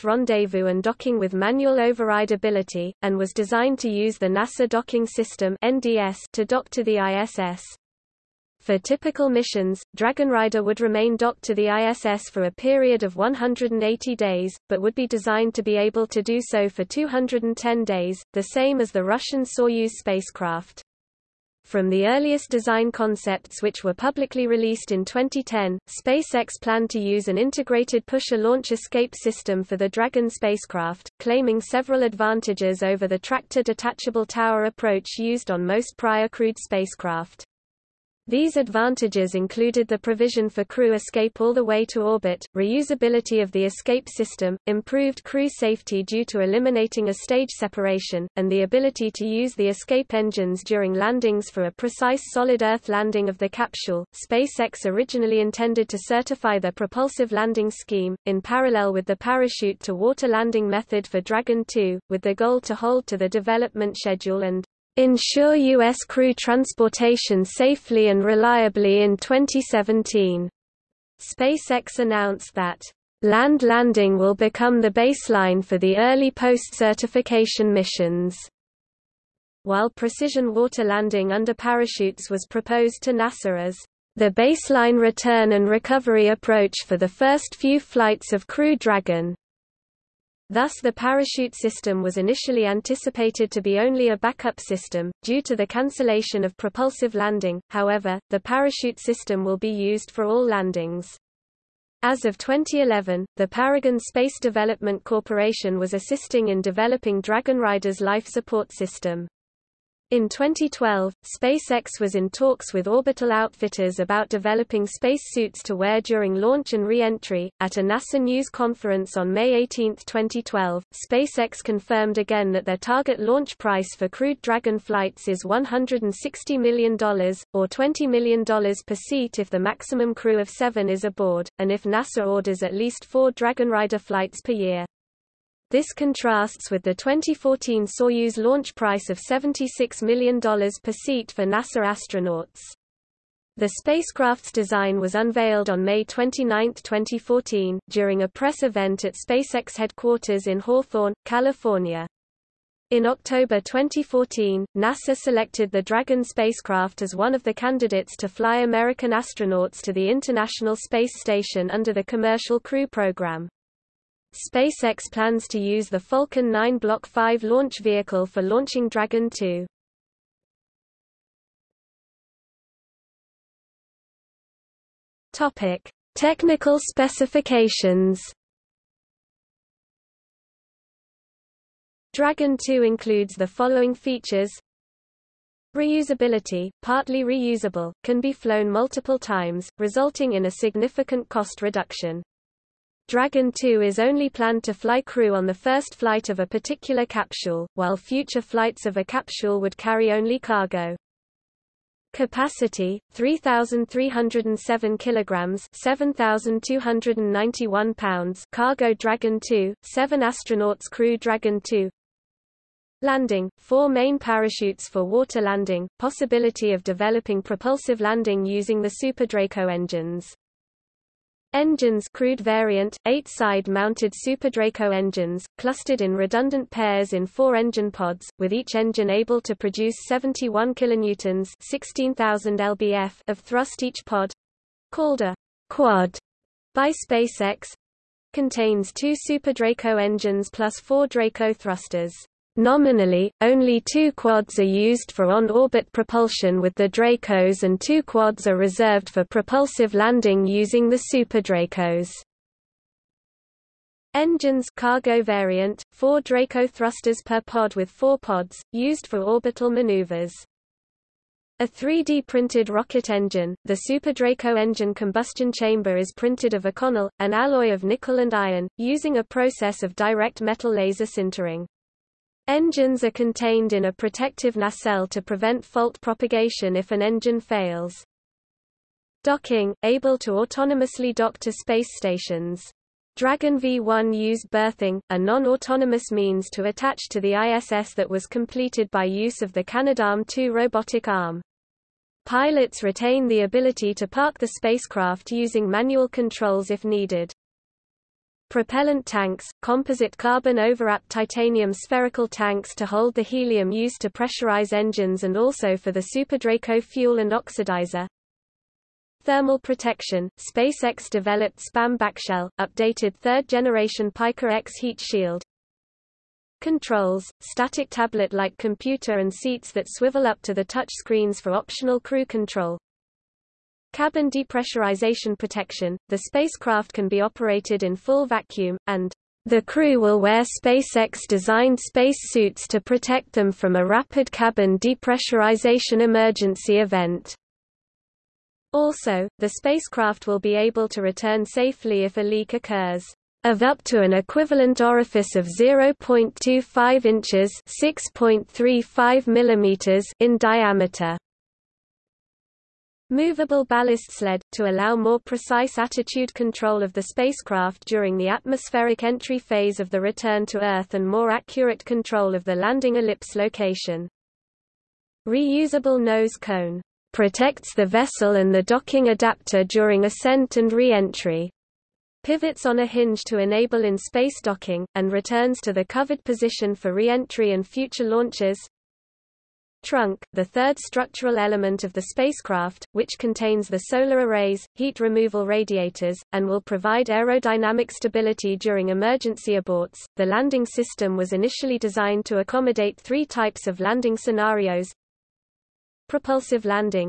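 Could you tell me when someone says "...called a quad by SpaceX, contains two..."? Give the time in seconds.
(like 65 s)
234 s.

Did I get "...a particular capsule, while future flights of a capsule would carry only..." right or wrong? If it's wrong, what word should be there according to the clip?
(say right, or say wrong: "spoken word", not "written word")
right.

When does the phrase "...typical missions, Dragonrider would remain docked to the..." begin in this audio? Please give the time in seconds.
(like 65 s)
8 s.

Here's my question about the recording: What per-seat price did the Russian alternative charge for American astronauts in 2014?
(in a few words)
$76 million.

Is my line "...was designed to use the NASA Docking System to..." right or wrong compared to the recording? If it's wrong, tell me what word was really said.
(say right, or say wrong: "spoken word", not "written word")
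right.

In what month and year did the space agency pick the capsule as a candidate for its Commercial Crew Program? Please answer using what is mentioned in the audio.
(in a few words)
October 2014.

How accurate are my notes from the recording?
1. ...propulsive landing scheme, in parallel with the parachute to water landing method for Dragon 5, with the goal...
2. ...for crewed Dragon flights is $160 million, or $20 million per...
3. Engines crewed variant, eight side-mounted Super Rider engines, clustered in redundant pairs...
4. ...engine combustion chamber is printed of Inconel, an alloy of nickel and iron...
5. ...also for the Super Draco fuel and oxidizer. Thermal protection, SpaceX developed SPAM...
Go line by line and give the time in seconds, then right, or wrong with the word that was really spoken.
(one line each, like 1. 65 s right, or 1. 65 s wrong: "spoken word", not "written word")
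1. 56 s wrong: "2", not "5"
2. 123 s right
3. 221 s wrong: "Draco", not "Rider"
4. 264 s right
5. 305 s right.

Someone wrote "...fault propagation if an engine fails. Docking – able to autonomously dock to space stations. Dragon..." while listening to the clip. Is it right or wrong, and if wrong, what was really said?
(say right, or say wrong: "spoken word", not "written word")
right.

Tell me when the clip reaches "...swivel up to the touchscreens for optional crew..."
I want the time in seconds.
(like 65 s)
319 s.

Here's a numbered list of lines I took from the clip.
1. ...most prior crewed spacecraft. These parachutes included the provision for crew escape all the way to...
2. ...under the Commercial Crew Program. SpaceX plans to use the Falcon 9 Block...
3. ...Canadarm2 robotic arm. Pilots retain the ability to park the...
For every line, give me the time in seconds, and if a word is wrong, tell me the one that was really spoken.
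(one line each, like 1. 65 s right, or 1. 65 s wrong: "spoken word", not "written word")
1. 35 s wrong: "advantages", not "parachutes"
2. 161 s right
3. 289 s right.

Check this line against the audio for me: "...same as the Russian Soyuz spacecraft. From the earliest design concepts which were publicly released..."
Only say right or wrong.
right.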